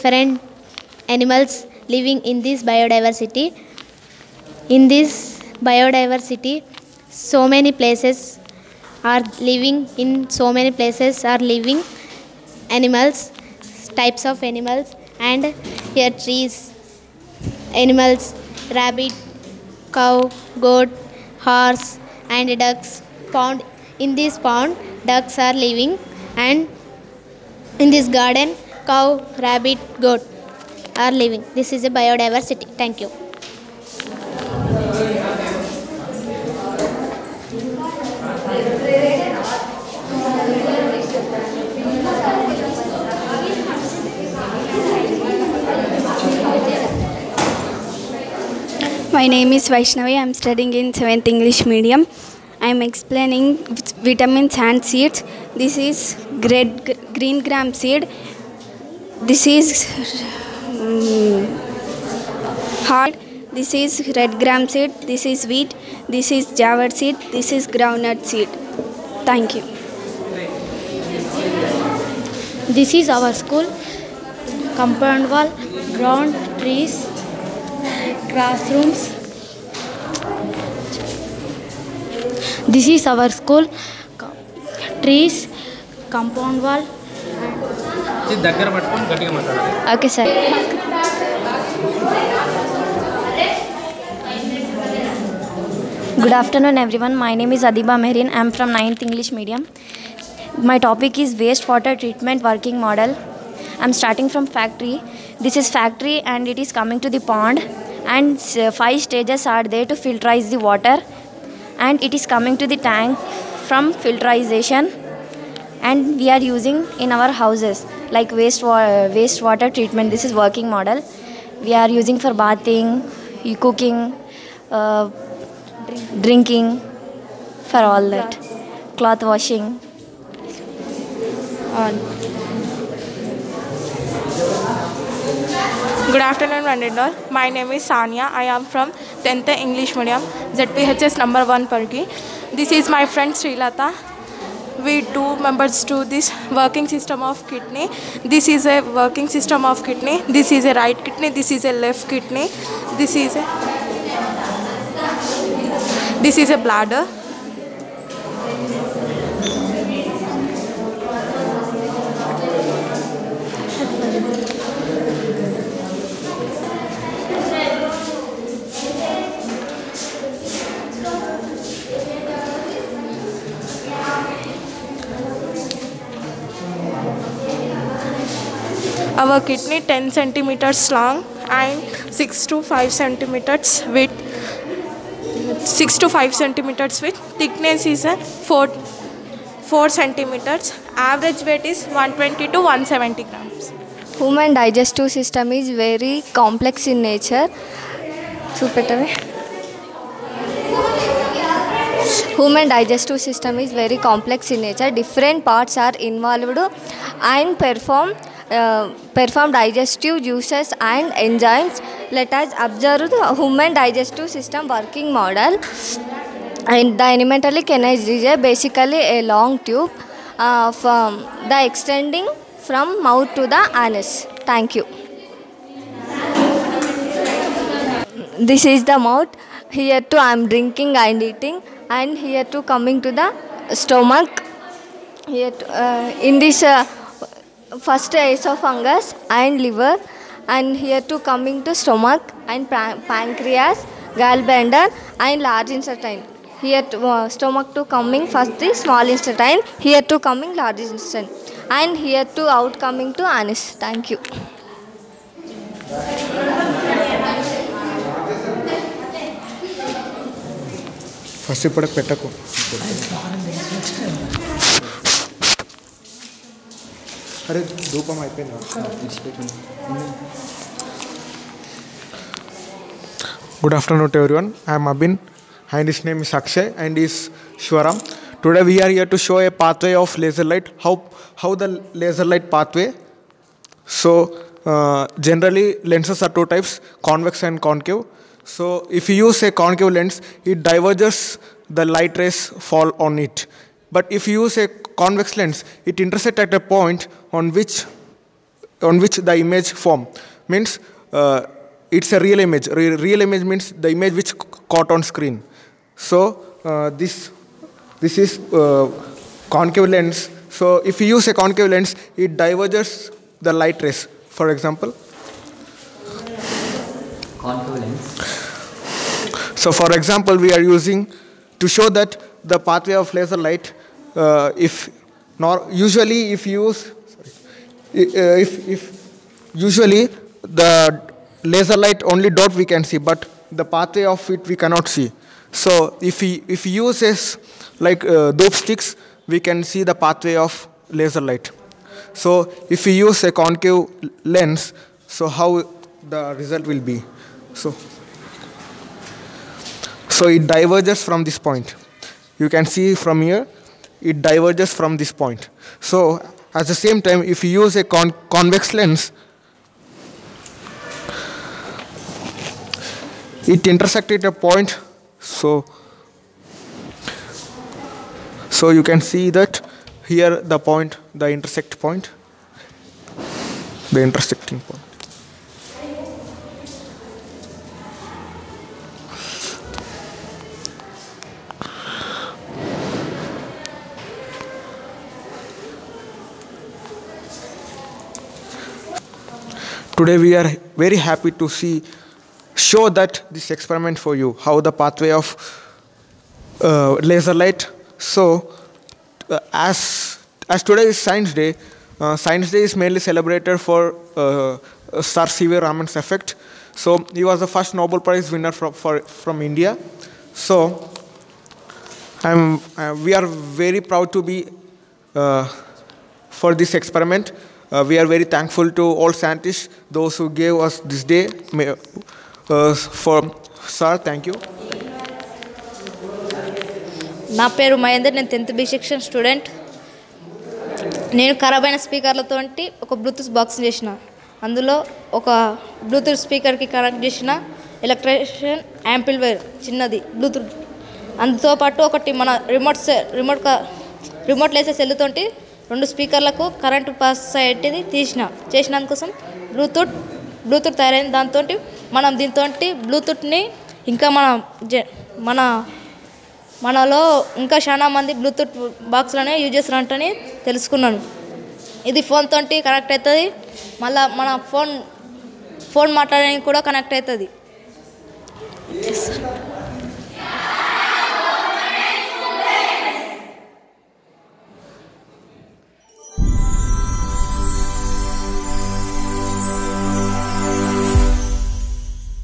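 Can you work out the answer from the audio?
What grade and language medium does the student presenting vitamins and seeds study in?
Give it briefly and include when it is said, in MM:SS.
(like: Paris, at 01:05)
7th English medium, at 00:50.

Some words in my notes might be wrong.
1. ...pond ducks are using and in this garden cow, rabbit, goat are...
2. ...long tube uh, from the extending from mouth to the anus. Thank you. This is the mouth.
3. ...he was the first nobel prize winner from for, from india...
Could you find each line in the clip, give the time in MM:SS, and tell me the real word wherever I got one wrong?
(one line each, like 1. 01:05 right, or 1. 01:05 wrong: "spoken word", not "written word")
1. 00:24 wrong: "living", not "using"
2. 03:39 right
3. 06:47 right.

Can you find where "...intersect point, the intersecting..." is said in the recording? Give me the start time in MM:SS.
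06:11.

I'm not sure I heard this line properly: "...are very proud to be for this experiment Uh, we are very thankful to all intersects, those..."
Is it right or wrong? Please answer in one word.
wrong.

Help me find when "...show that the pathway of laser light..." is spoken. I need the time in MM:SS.
05:21.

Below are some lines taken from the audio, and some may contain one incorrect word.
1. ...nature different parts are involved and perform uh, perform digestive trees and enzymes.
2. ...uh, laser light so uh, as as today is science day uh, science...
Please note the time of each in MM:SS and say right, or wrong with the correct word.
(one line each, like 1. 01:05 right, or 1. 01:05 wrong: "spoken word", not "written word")
1. 03:24 wrong: "juices", not "trees"
2. 06:36 right.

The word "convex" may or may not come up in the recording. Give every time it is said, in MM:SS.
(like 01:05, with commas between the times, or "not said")
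04:54, 05:58.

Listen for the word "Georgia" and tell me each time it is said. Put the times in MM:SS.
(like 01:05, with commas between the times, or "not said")
not said.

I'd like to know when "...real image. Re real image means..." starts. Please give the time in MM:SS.
05:02.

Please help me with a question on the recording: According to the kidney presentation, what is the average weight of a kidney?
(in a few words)
120 to 170 grams.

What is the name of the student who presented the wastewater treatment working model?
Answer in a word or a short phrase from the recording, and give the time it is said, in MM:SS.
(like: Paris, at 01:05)
Adiba Mehrin, at 01:37.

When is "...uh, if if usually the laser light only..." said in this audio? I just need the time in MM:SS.
05:26.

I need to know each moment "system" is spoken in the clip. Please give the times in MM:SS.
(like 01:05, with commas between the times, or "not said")
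03:15, 03:23, 03:34.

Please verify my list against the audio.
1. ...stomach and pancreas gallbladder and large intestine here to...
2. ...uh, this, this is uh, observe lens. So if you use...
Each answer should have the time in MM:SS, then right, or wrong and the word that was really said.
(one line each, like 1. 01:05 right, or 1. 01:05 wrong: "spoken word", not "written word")
1. 04:01 right
2. 05:06 wrong: "concave", not "observe".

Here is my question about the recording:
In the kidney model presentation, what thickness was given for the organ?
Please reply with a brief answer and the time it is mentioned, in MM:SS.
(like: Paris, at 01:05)
4 centimeters, at 03:07.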